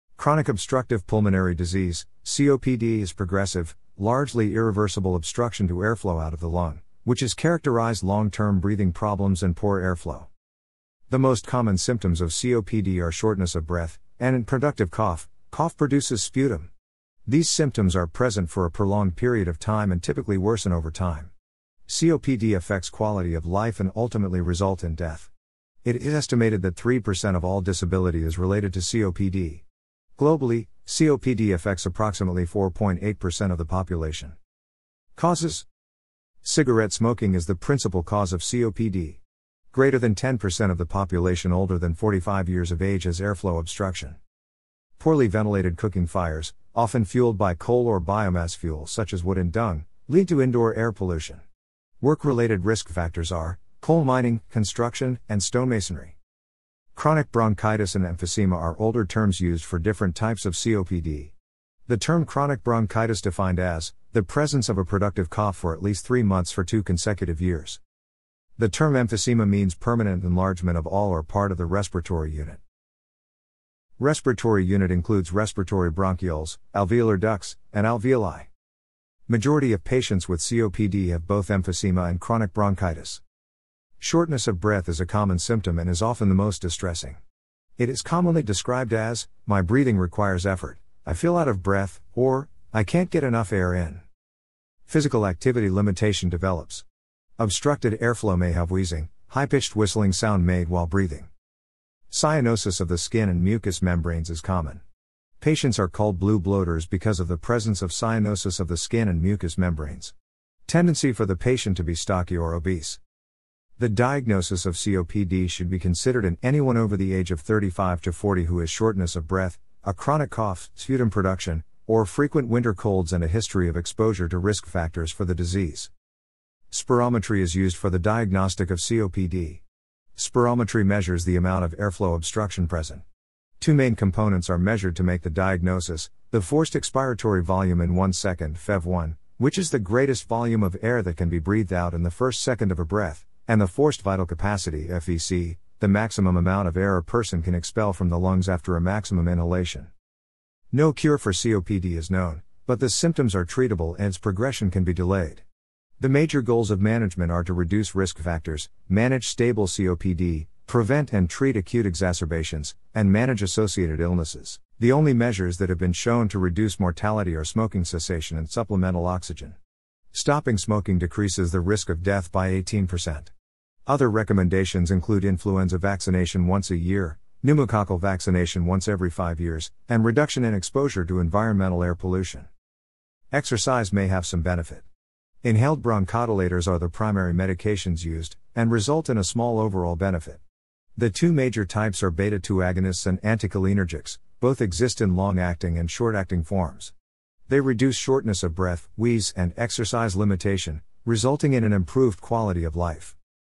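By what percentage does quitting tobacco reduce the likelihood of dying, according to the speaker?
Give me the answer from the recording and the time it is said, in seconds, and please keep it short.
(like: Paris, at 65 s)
18%, at 172 s.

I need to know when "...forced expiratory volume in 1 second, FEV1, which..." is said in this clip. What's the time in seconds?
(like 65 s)
136 s.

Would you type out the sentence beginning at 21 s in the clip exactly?
COPD affects quality of life and ultimately result in death.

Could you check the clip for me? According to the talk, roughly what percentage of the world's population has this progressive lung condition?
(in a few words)
4.8%.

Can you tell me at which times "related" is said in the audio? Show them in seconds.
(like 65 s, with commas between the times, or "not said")
28 s, 52 s.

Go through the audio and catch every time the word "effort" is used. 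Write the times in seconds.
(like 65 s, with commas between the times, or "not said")
90 s.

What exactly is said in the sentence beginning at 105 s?
Patients are called blue bloaters because of the presence of cyanosis of the skin and mucous membranes.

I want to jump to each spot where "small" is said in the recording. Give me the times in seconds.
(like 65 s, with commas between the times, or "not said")
189 s.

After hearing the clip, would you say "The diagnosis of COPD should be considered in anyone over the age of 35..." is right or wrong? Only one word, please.
right.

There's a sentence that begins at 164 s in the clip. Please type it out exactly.
The only measures that have been shown to reduce mortality are smoking cessation and supplemental oxygen.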